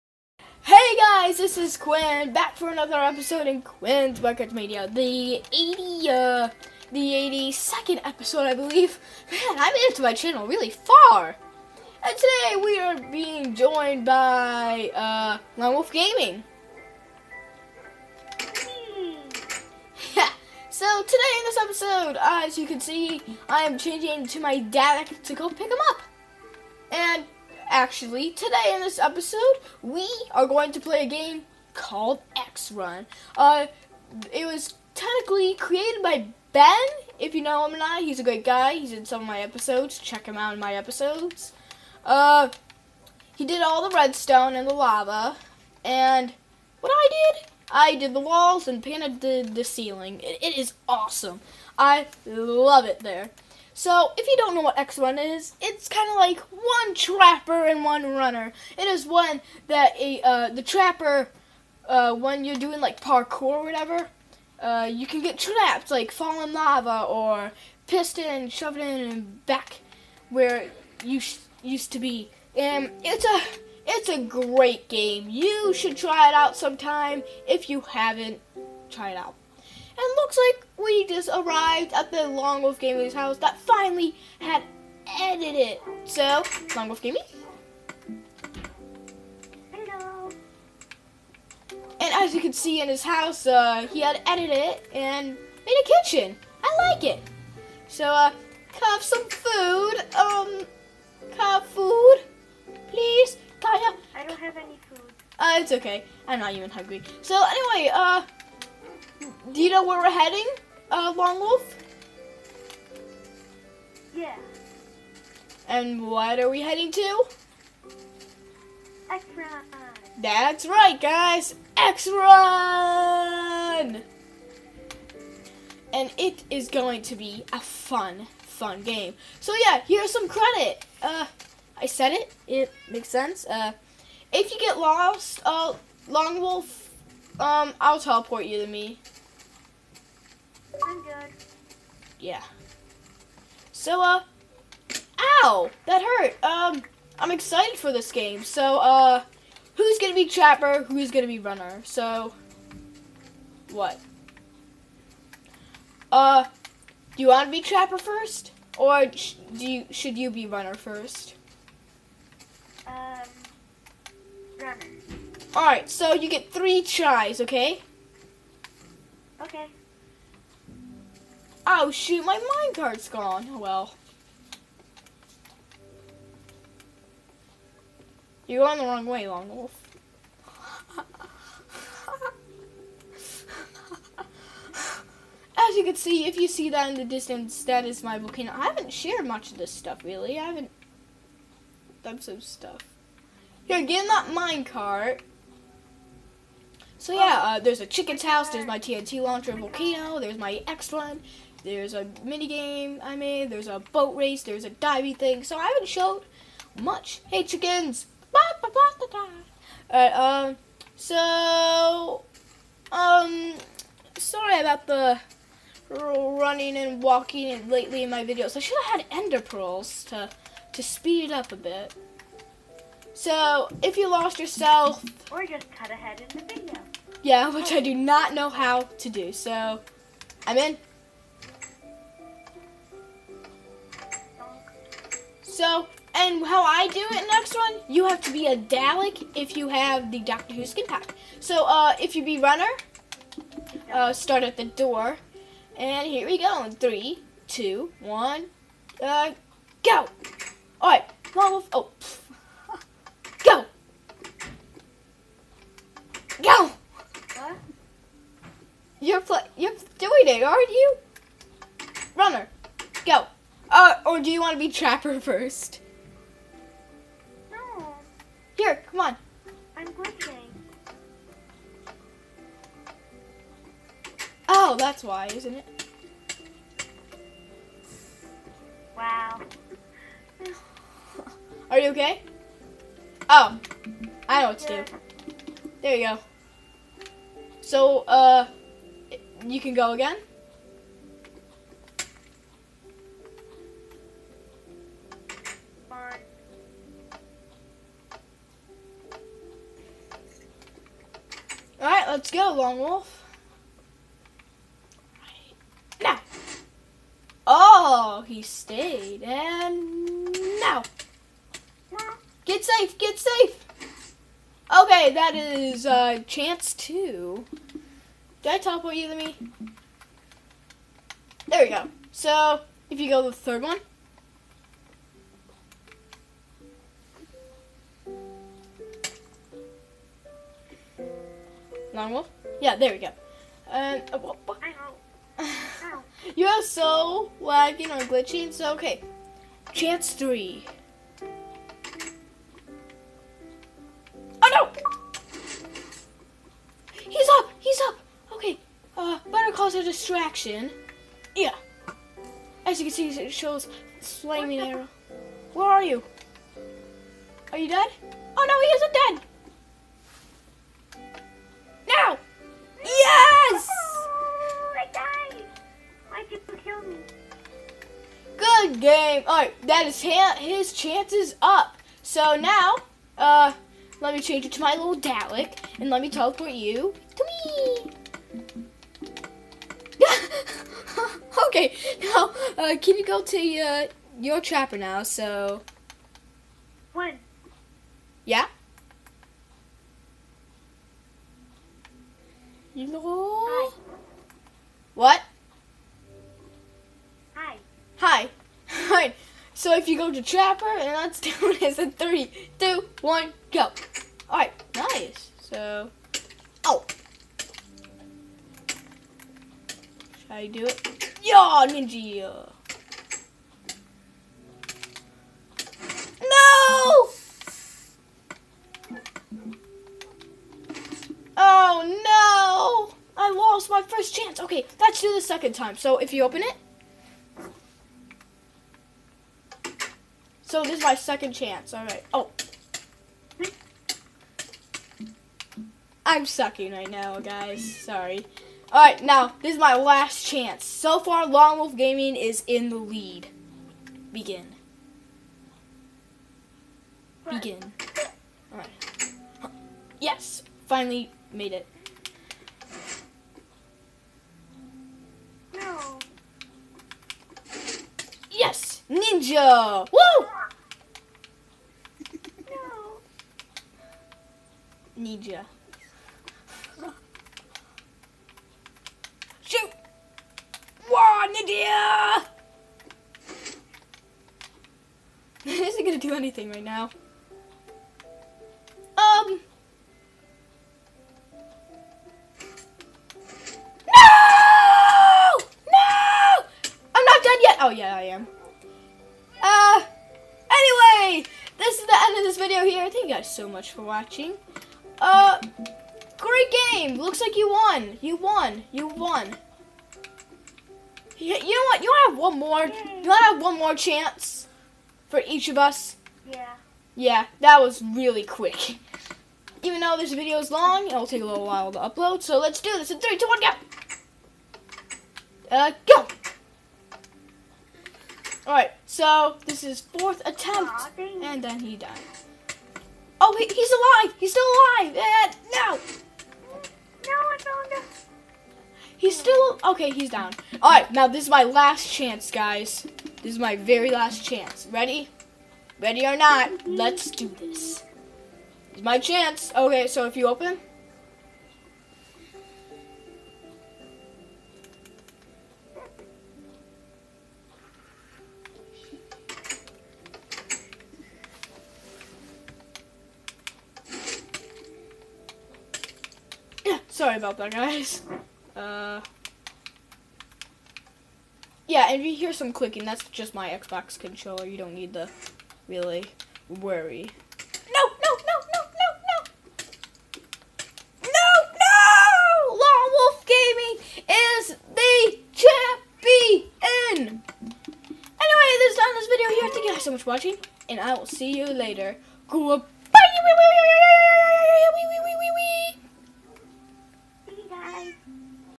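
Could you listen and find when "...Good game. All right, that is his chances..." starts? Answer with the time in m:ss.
6:08.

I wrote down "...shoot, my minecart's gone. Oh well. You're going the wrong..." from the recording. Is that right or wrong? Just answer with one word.
right.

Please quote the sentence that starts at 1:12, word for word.
And it's a it's a great game.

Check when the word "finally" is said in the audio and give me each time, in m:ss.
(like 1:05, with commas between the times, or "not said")
1:23, 7:30.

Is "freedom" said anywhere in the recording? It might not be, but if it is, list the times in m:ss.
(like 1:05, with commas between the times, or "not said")
not said.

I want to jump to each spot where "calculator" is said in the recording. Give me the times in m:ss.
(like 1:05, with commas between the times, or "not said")
not said.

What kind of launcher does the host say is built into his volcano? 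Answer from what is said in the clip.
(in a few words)
TNT launcher.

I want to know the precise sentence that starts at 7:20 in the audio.
So far, Long Wolf Gaming is in the lead.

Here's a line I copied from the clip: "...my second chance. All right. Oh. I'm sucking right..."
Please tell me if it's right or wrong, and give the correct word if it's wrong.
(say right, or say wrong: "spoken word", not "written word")
right.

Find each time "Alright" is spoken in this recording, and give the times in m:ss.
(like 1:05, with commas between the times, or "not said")
3:29, 4:10, 6:38, 6:44, 8:50.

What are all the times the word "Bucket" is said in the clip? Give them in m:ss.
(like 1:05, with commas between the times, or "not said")
0:04.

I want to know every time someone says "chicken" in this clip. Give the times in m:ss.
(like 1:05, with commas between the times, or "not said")
3:17, 3:27.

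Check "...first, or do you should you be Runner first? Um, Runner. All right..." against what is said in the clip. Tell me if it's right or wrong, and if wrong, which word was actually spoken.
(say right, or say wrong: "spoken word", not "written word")
right.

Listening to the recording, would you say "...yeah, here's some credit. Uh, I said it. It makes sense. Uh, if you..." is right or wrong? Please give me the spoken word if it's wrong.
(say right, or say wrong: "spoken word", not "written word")
right.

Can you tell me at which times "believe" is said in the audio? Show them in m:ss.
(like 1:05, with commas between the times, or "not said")
0:08.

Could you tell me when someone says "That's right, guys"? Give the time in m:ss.
2:00.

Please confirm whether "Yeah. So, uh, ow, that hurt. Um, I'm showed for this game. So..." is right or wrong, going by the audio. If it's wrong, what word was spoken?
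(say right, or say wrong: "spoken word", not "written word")
wrong: "excited", not "showed".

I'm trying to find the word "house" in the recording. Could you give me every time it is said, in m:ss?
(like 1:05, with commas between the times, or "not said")
1:23, 1:33, 3:18.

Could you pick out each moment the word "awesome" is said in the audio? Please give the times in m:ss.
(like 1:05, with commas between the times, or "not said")
0:50.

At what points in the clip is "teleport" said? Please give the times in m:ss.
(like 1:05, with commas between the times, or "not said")
2:17, 5:18, 6:16.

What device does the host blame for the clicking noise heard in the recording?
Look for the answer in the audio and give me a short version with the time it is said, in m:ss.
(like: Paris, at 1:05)
Xbox controller, at 9:23.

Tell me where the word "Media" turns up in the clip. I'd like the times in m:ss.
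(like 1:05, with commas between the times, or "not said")
0:04.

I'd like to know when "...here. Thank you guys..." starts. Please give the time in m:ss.
9:39.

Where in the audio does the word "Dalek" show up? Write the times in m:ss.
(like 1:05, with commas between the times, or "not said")
3:58, 6:14.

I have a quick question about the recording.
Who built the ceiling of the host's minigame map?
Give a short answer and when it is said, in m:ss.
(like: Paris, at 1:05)
Panda, at 0:48.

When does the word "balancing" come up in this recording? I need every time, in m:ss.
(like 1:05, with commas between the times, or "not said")
not said.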